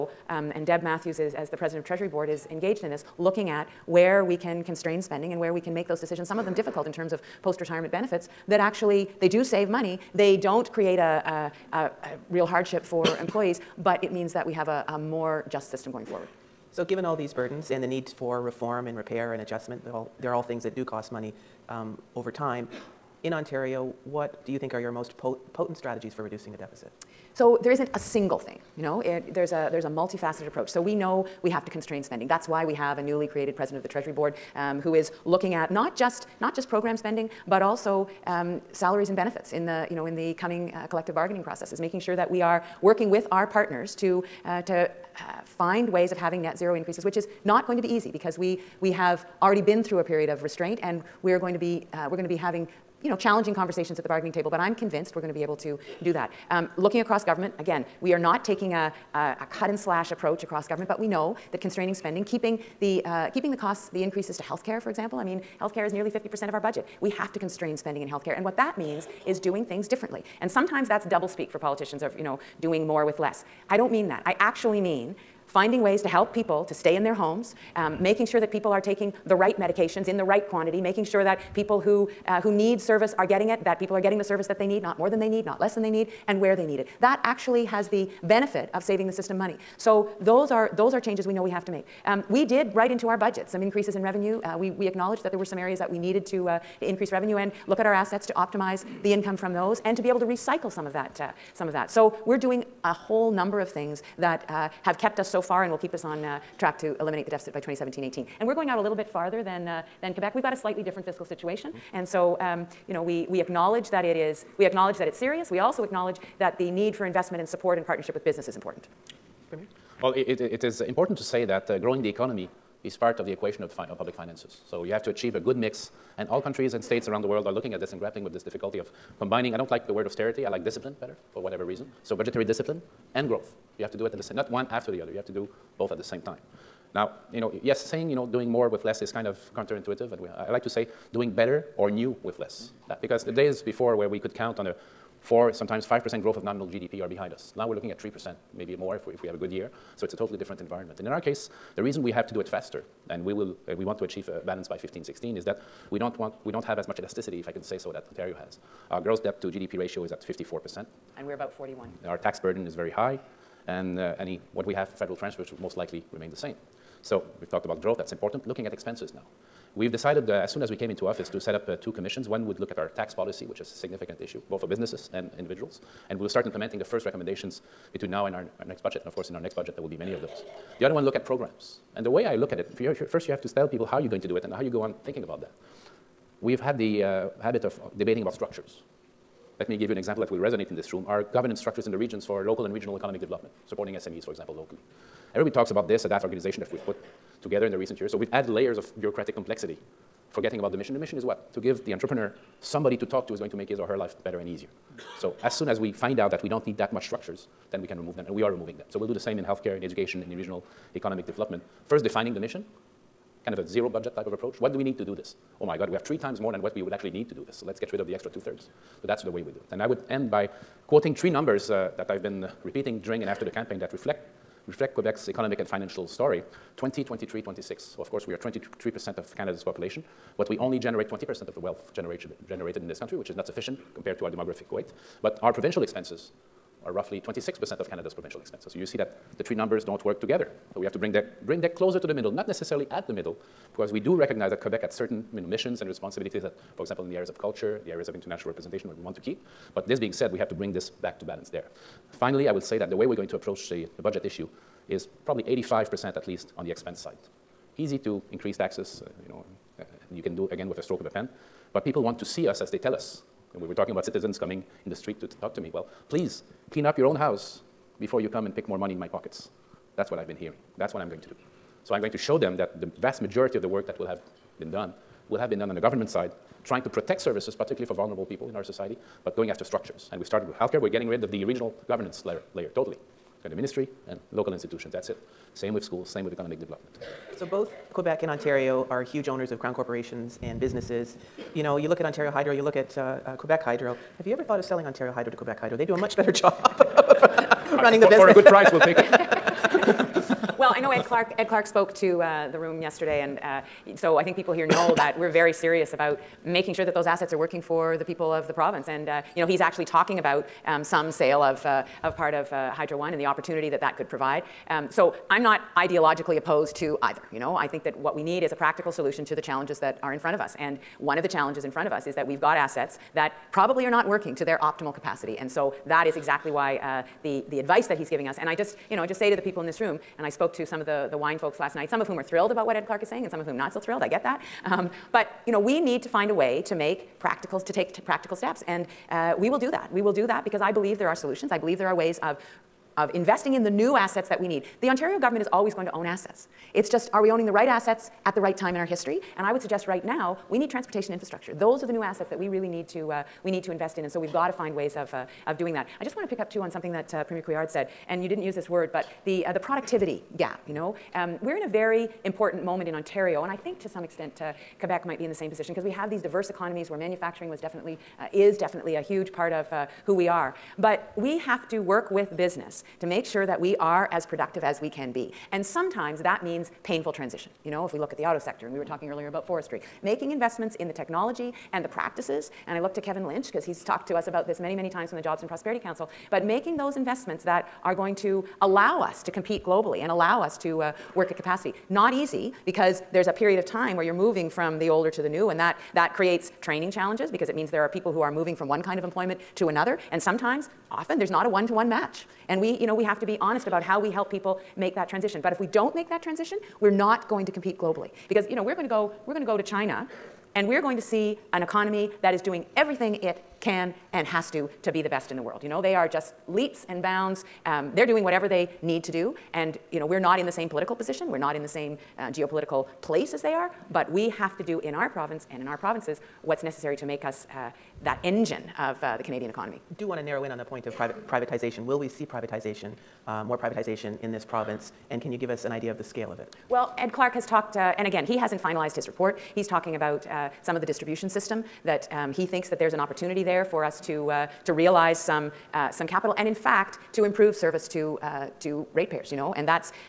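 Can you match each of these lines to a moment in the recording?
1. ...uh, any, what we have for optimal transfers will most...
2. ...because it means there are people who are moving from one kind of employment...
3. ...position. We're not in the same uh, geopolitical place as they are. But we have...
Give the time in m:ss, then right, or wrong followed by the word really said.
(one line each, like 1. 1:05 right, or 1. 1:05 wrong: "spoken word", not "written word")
1. 2:43 wrong: "federal", not "optimal"
2. 6:37 right
3. 7:00 right.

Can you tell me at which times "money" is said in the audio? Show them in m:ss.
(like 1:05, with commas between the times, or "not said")
0:09, 0:21, 1:29, 4:28.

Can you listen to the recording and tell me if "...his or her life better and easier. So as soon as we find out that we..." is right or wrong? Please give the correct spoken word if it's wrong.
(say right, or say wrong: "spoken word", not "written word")
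right.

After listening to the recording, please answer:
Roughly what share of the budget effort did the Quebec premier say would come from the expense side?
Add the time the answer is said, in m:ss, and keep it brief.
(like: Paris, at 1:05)
85%, at 4:15.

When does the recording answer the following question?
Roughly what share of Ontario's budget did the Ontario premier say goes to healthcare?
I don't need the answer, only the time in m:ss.
1:05.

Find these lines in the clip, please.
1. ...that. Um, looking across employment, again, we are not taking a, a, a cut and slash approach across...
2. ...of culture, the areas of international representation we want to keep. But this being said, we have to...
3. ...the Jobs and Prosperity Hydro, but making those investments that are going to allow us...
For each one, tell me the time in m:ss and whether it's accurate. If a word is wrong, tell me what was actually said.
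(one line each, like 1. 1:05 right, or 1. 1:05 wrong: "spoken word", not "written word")
1. 0:56 wrong: "government", not "employment"
2. 4:07 right
3. 6:25 wrong: "Council", not "Hydro".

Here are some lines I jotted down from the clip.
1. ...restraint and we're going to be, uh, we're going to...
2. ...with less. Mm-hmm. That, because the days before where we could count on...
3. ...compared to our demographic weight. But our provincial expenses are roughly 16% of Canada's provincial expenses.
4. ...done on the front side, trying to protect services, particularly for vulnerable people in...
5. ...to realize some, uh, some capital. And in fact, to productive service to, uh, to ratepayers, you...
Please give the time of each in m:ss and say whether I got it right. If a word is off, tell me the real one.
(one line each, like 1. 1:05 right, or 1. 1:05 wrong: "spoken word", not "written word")
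1. 0:50 right
2. 2:22 right
3. 3:53 wrong: "26", not "16"
4. 4:35 wrong: "government", not "front"
5. 7:24 wrong: "improve", not "productive".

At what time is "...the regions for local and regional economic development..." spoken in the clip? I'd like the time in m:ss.
3:11.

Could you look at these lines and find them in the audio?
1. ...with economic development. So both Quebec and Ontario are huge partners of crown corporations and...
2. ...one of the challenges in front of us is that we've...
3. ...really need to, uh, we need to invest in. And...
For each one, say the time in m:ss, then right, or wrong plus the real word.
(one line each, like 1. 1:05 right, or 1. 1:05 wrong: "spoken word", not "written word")
1. 4:46 wrong: "owners", not "partners"
2. 5:20 right
3. 5:52 right.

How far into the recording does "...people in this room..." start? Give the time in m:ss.
5:29.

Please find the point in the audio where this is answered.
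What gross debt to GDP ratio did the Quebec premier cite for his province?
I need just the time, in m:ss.
2:40.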